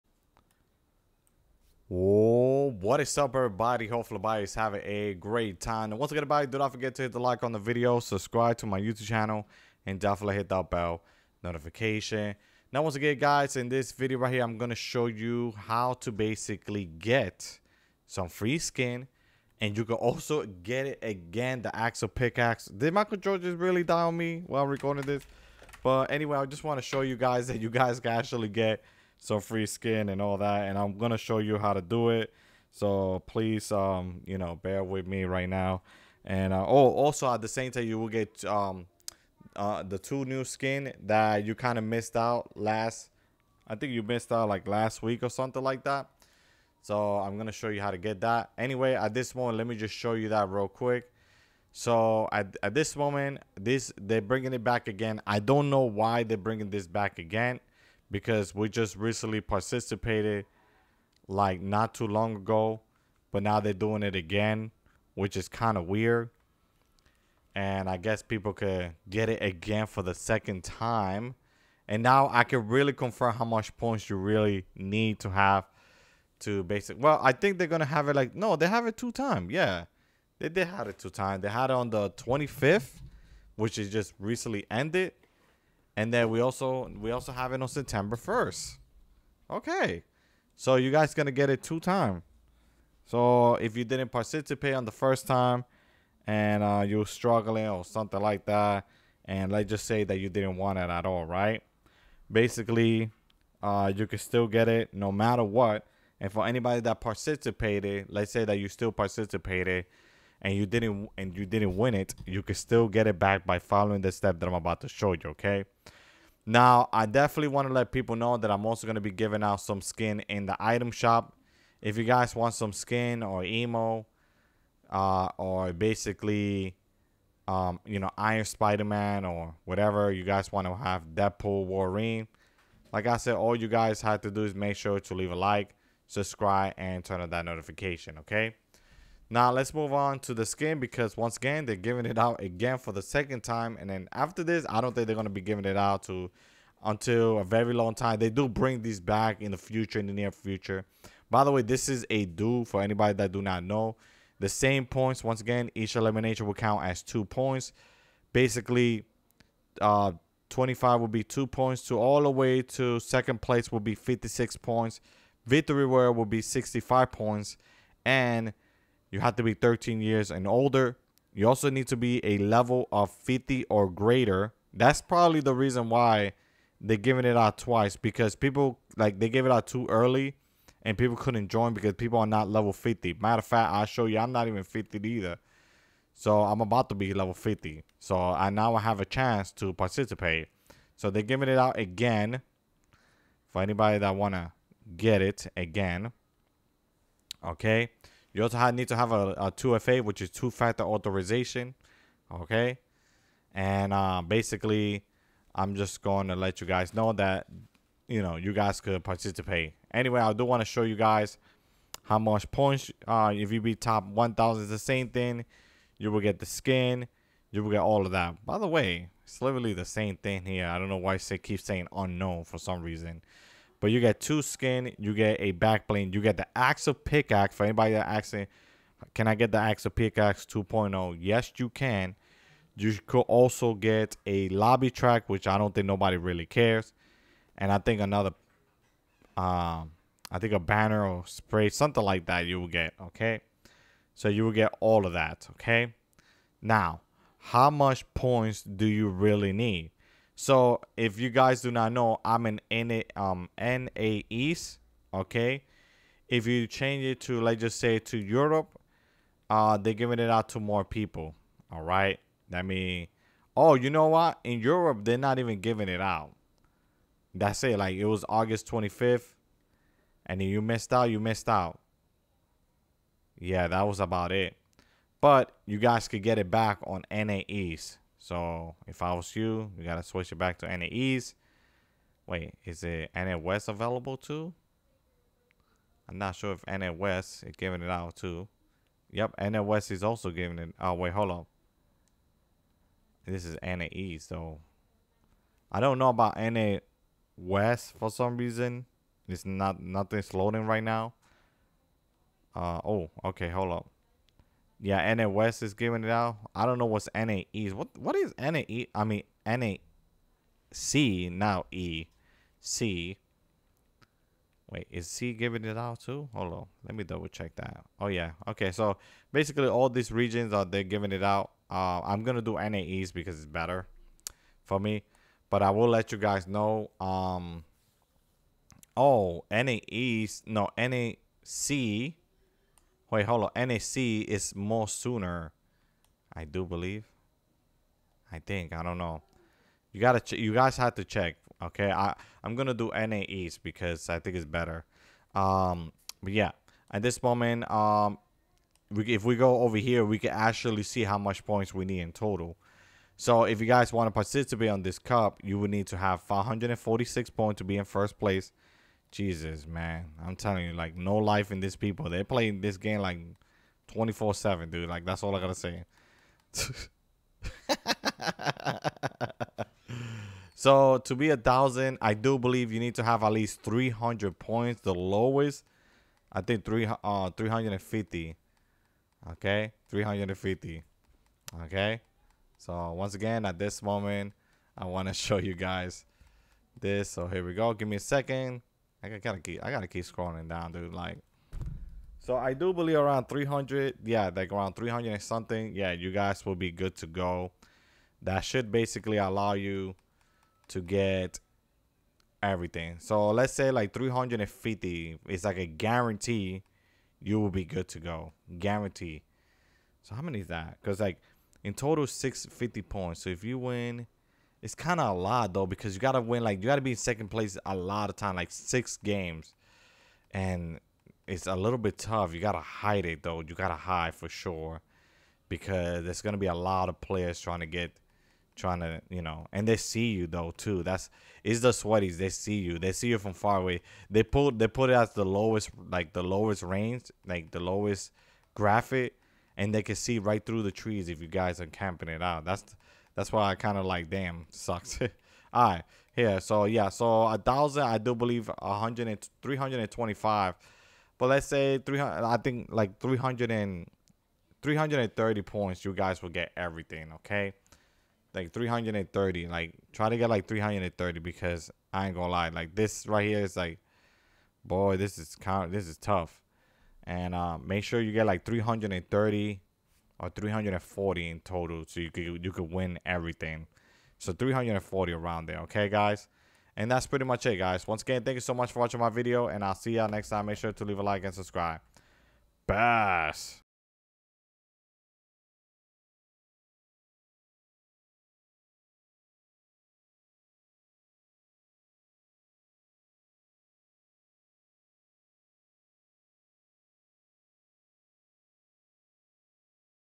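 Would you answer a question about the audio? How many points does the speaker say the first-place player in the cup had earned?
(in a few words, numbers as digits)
546.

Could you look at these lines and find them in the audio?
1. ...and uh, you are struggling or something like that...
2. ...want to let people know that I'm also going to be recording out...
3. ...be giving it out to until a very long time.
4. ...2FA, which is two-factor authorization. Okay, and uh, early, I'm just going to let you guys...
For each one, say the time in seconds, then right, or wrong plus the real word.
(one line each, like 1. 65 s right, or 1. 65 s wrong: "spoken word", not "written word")
1. 96 s right
2. 117 s wrong: "giving", not "recording"
3. 145 s right
4. 199 s wrong: "basically", not "early".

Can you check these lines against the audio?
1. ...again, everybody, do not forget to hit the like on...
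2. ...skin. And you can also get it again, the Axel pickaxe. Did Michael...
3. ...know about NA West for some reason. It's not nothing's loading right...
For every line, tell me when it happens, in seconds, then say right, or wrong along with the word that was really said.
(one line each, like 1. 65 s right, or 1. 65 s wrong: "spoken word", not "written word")
1. 6 s right
2. 18 s right
3. 295 s right.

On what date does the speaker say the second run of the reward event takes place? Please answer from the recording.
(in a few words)
September 1.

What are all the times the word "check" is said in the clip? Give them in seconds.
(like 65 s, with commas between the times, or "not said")
317 s, 341 s.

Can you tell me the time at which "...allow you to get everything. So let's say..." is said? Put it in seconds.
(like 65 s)
399 s.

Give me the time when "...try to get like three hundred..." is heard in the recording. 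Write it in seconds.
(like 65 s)
459 s.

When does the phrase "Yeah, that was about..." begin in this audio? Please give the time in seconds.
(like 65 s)
273 s.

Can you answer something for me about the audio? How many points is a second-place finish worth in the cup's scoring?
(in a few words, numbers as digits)
56.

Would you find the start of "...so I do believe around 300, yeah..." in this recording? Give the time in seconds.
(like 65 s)
392 s.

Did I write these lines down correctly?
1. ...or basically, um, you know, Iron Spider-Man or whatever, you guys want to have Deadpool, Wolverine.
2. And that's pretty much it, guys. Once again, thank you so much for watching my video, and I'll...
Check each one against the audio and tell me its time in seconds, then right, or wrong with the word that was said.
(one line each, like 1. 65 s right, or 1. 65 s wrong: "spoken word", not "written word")
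1. 125 s right
2. 476 s right.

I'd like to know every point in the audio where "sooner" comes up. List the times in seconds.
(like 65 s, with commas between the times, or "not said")
334 s.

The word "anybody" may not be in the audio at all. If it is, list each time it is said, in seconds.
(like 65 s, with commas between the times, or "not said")
106 s, 152 s, 193 s, 227 s.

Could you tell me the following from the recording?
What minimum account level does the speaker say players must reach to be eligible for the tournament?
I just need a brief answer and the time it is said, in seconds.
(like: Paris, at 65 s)
50, at 172 s.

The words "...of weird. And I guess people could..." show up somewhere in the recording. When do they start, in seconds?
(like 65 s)
65 s.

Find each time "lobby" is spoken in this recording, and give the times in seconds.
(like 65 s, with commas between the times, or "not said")
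234 s.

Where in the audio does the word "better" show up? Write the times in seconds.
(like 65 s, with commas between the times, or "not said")
323 s, 344 s.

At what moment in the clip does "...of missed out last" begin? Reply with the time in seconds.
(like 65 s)
41 s.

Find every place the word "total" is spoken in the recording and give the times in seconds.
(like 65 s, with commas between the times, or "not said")
352 s, 411 s, 471 s.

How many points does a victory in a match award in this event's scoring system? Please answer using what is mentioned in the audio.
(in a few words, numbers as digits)
65.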